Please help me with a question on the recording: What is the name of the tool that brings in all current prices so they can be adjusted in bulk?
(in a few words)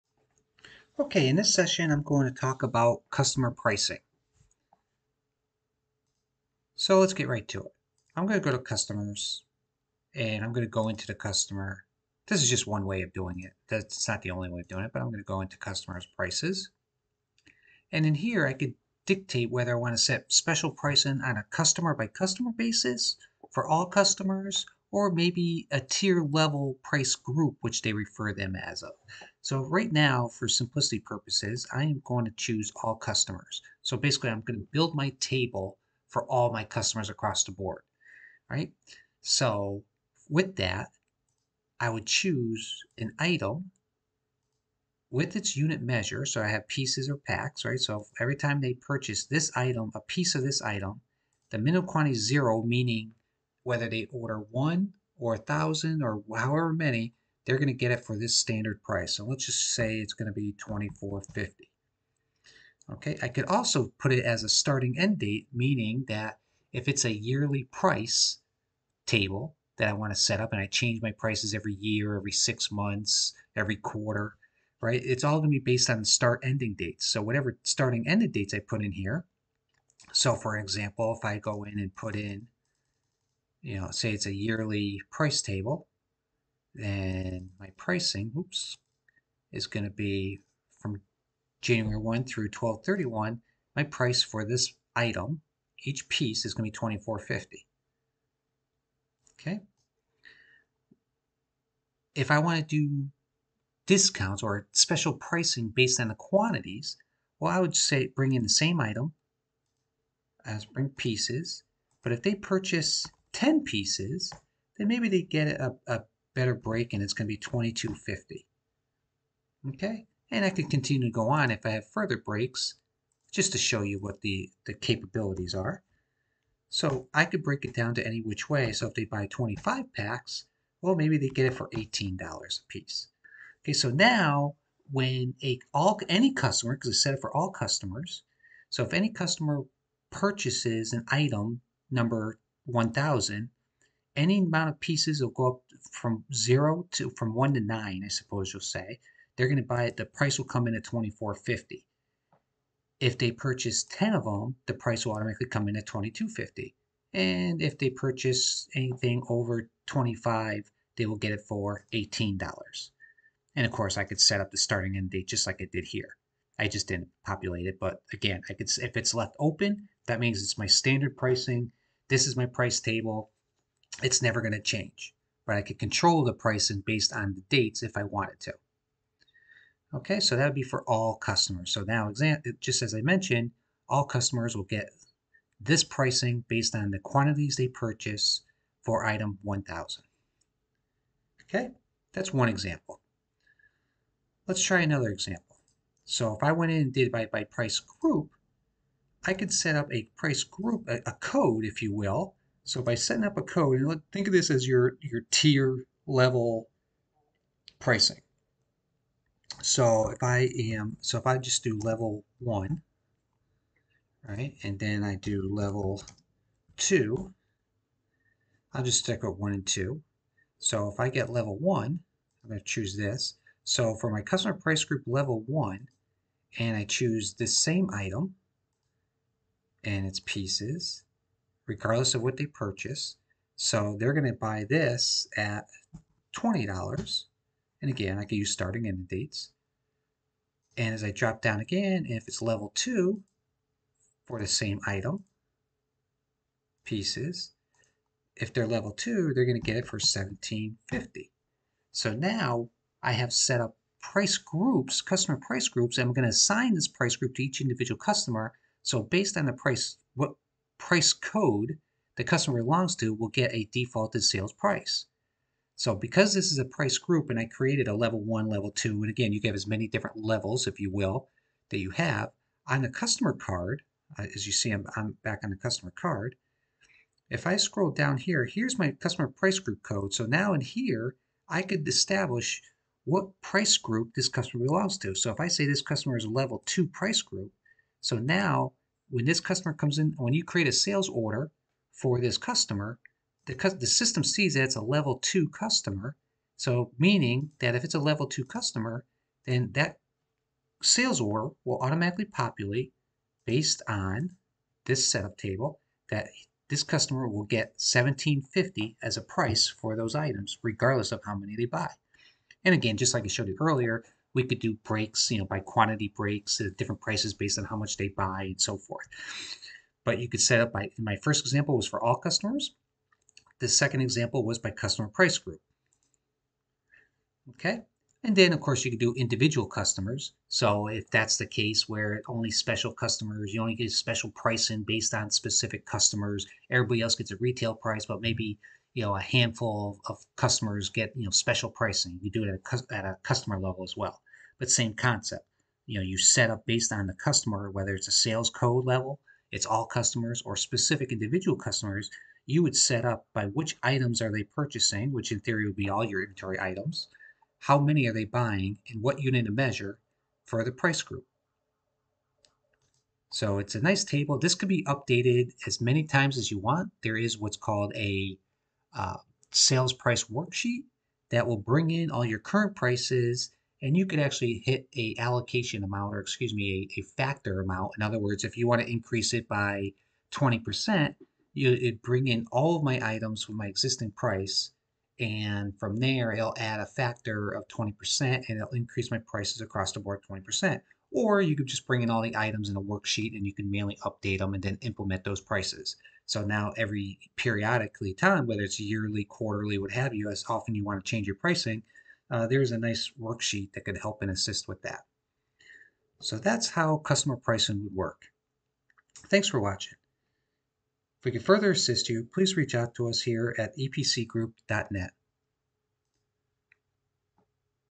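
Sales price worksheet.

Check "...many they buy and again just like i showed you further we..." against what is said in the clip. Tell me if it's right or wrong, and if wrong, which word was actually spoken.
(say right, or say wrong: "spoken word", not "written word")
wrong: "earlier", not "further".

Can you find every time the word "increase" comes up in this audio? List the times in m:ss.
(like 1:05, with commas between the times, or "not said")
6:18, 6:28.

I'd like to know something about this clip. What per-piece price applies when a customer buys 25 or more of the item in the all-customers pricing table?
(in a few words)
$18.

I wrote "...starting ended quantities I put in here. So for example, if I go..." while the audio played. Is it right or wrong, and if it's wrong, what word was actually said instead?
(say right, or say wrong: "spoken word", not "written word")
wrong: "dates", not "quantities".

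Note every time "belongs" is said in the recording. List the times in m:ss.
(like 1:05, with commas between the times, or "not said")
4:22, 4:44.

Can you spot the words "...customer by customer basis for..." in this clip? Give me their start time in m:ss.
0:21.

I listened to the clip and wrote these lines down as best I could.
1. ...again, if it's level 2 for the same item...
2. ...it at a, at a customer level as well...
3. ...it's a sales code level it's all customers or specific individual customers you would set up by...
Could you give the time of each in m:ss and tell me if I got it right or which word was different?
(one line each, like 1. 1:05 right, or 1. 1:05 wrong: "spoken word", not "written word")
1. 4:01 right
2. 5:42 right
3. 5:47 right.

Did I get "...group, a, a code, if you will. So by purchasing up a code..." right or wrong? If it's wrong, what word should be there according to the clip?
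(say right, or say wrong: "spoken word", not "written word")
wrong: "setting", not "purchasing".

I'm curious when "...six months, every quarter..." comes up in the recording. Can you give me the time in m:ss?
1:12.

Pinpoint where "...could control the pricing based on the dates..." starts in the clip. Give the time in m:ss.
2:55.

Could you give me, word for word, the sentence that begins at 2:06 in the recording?
So I could break it down to any which way.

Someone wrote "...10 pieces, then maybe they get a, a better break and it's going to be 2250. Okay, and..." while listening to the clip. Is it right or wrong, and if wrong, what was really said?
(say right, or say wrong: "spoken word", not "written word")
right.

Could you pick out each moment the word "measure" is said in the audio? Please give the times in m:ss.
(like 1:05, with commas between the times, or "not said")
0:45, 5:59.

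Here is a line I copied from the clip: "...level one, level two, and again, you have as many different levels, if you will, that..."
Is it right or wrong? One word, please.
right.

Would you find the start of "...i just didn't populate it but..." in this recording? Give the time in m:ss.
2:46.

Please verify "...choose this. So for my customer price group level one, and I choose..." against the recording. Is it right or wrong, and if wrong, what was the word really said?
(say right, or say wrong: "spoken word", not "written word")
right.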